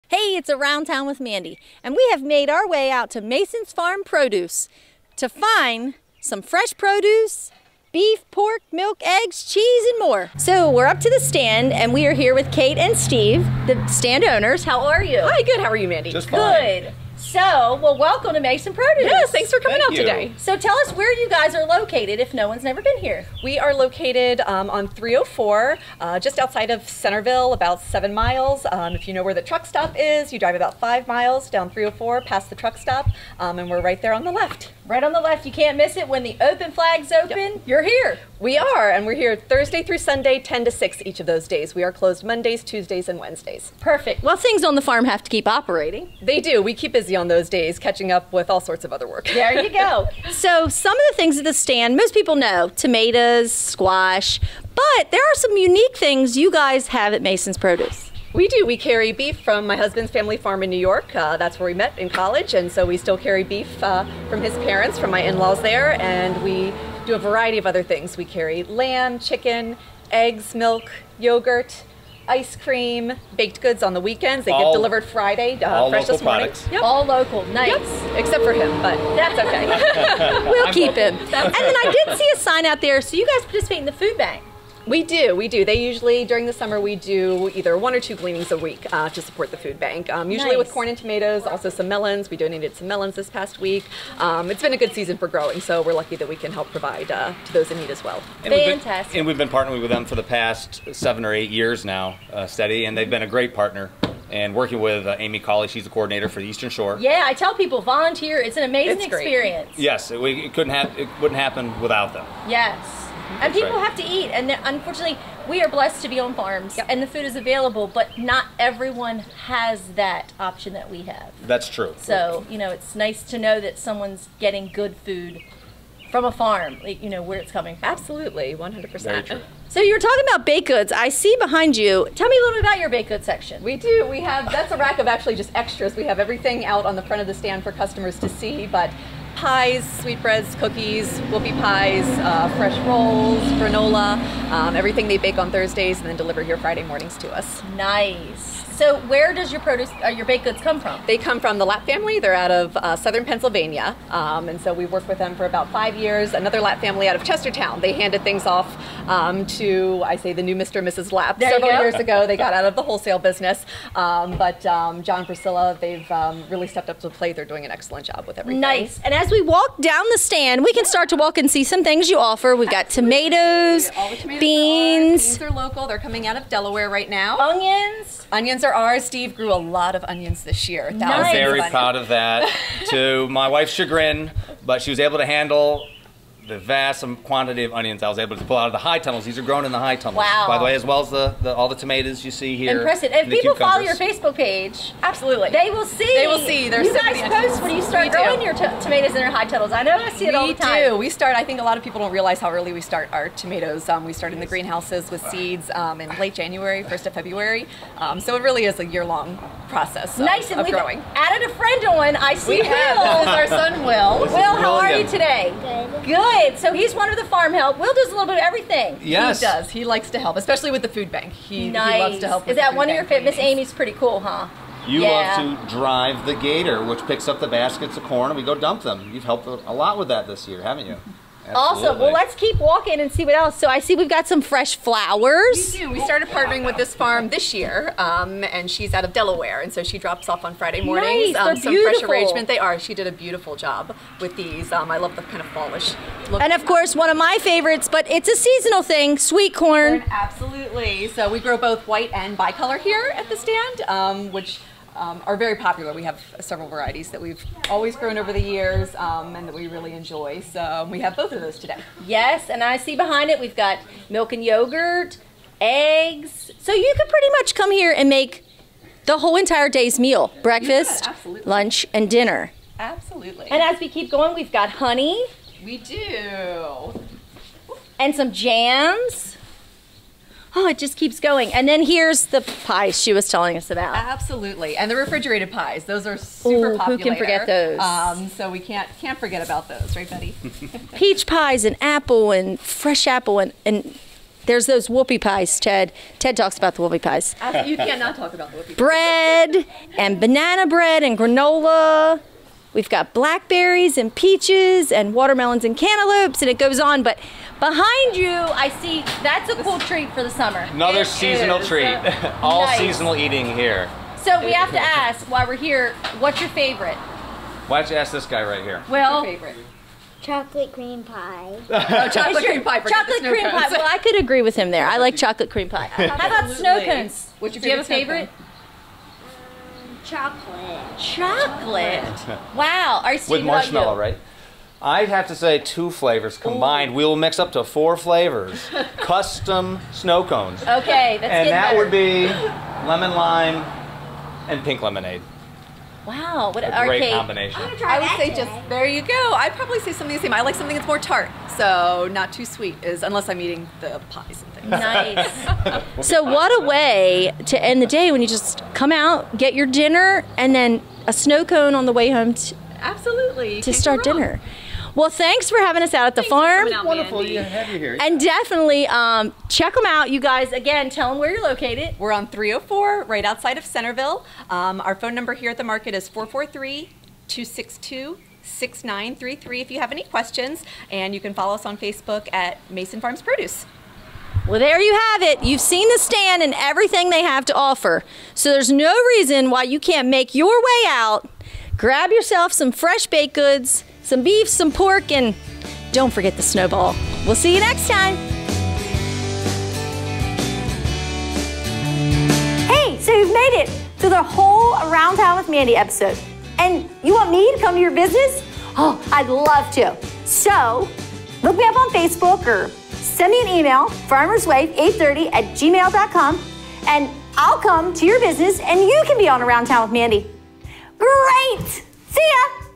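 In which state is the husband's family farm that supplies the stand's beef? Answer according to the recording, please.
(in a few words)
New York.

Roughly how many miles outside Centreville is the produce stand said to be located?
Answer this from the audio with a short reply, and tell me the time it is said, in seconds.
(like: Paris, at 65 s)
7, at 27 s.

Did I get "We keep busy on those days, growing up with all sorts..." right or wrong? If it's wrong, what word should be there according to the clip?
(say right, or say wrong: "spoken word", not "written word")
wrong: "catching", not "growing".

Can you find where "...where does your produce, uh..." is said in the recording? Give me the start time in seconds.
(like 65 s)
149 s.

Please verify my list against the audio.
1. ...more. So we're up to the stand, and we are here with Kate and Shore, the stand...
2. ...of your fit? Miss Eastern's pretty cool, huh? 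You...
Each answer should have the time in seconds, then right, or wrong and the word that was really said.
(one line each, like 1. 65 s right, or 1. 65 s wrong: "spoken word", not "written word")
1. 9 s wrong: "Steve", not "Shore"
2. 222 s wrong: "Amy", not "Eastern".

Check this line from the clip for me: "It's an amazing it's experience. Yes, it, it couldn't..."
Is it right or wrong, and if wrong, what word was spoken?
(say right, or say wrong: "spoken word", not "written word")
right.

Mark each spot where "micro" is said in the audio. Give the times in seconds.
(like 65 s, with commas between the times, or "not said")
not said.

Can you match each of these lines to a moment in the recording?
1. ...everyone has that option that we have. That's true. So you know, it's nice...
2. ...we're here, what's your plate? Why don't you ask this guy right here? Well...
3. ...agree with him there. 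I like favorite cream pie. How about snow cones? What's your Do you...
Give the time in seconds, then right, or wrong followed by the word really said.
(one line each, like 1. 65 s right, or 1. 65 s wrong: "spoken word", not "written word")
1. 118 s right
2. 315 s wrong: "favorite", not "plate"
3. 324 s wrong: "chocolate", not "favorite".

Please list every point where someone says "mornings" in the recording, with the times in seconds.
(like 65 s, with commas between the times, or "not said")
76 s, 146 s, 240 s.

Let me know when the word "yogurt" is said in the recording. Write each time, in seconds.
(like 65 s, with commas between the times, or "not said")
71 s, 264 s.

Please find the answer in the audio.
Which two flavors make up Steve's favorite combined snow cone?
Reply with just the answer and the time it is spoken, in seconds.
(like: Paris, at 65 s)
Lemon lime and pink lemonade, at 342 s.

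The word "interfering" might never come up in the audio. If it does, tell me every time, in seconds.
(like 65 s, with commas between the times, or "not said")
not said.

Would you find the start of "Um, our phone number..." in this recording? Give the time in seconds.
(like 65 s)
374 s.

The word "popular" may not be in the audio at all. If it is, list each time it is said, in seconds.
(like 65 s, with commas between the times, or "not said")
255 s, 286 s.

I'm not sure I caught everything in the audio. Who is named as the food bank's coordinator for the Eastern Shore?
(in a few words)
Amy Colley.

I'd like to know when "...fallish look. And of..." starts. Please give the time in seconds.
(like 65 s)
245 s.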